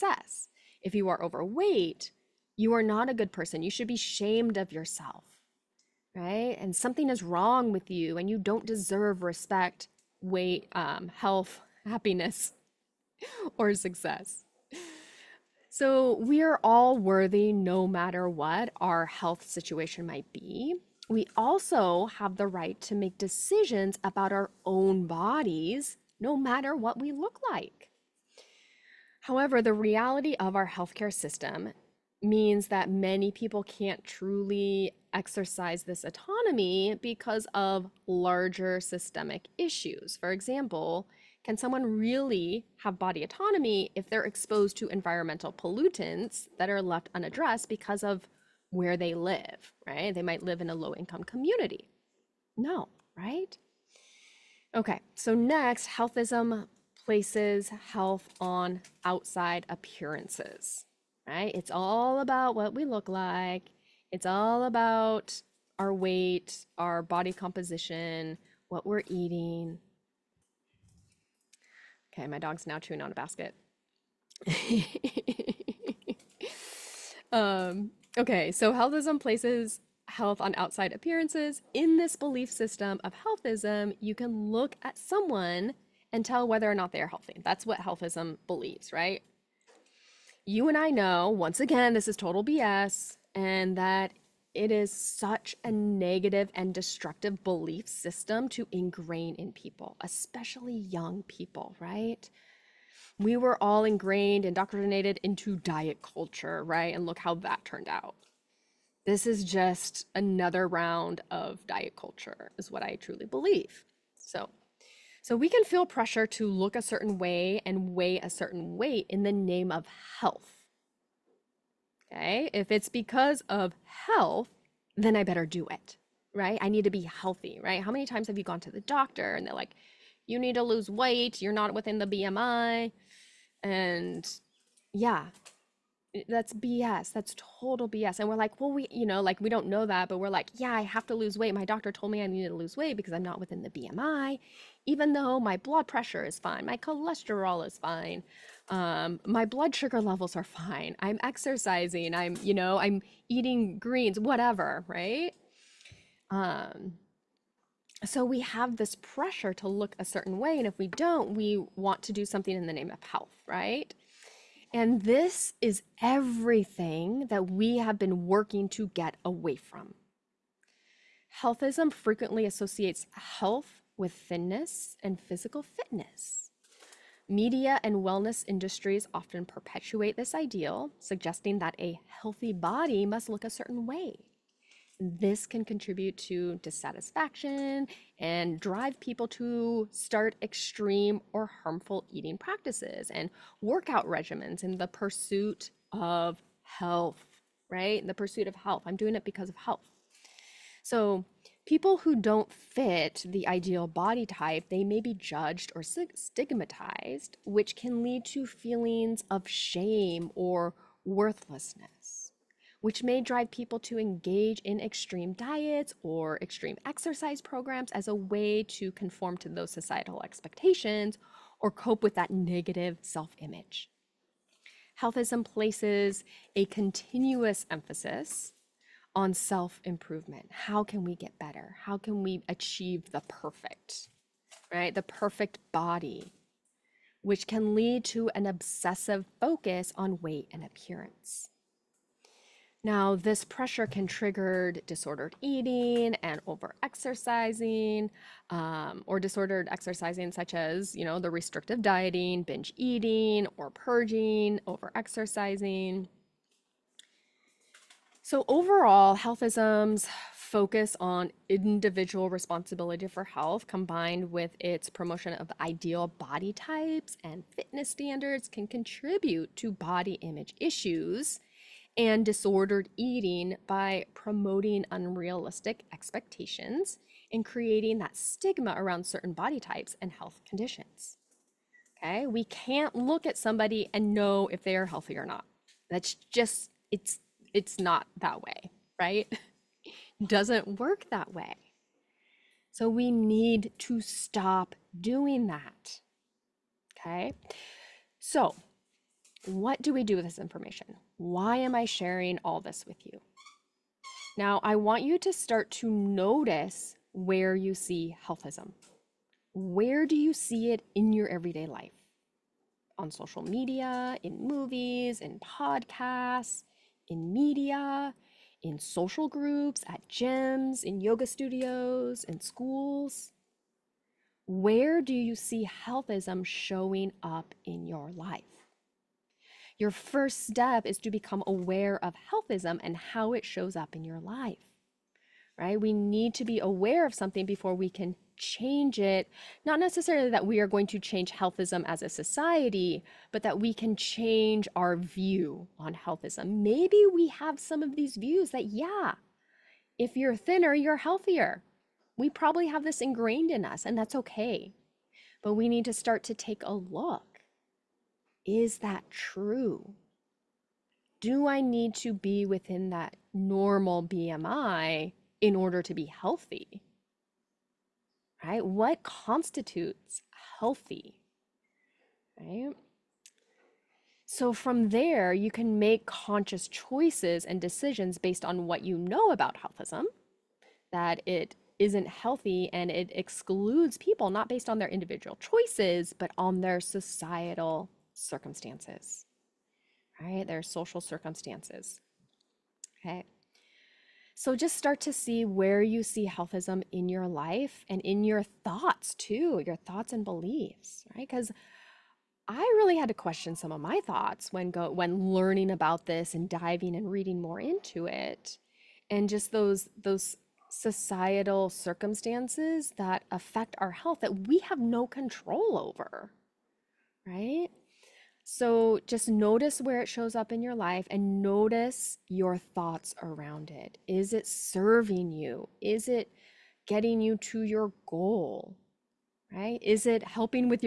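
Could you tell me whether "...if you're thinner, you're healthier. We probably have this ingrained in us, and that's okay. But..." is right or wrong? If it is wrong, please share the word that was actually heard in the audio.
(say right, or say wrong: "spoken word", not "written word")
right.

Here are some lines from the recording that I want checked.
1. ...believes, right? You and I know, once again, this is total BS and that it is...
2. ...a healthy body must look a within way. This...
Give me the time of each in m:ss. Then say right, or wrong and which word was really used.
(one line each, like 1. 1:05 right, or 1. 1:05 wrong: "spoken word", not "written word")
1. 1:28 right
2. 3:01 wrong: "certain", not "within".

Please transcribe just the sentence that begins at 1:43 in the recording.
We were all ingrained, indoctrinated into diet culture, right?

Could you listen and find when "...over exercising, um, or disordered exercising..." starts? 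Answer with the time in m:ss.
4:06.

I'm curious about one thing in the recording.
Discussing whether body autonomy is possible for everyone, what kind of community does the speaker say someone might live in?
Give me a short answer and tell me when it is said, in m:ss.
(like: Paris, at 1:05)
low income community, at 0:50.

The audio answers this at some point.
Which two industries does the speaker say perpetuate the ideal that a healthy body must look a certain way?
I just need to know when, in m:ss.
2:57.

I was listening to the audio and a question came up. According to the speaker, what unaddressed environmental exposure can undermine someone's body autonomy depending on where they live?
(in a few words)
environmental pollutants.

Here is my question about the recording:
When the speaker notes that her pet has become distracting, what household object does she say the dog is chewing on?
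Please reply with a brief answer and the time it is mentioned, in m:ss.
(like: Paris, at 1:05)
basket, at 1:13.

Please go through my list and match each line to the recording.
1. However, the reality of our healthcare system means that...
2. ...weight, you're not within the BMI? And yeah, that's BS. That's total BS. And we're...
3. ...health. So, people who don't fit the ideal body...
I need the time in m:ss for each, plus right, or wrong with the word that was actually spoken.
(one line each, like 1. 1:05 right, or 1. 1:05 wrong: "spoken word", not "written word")
1. 0:29 right
2. 2:10 right
3. 3:19 right.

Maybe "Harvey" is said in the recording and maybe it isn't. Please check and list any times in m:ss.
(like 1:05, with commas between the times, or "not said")
not said.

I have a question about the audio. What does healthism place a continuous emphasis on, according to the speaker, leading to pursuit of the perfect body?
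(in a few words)
self improvement.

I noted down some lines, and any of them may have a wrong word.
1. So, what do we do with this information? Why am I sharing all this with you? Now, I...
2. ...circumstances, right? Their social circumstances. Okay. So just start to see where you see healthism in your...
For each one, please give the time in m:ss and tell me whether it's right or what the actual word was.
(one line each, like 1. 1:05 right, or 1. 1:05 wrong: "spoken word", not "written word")
1. 4:58 right
2. 6:28 right.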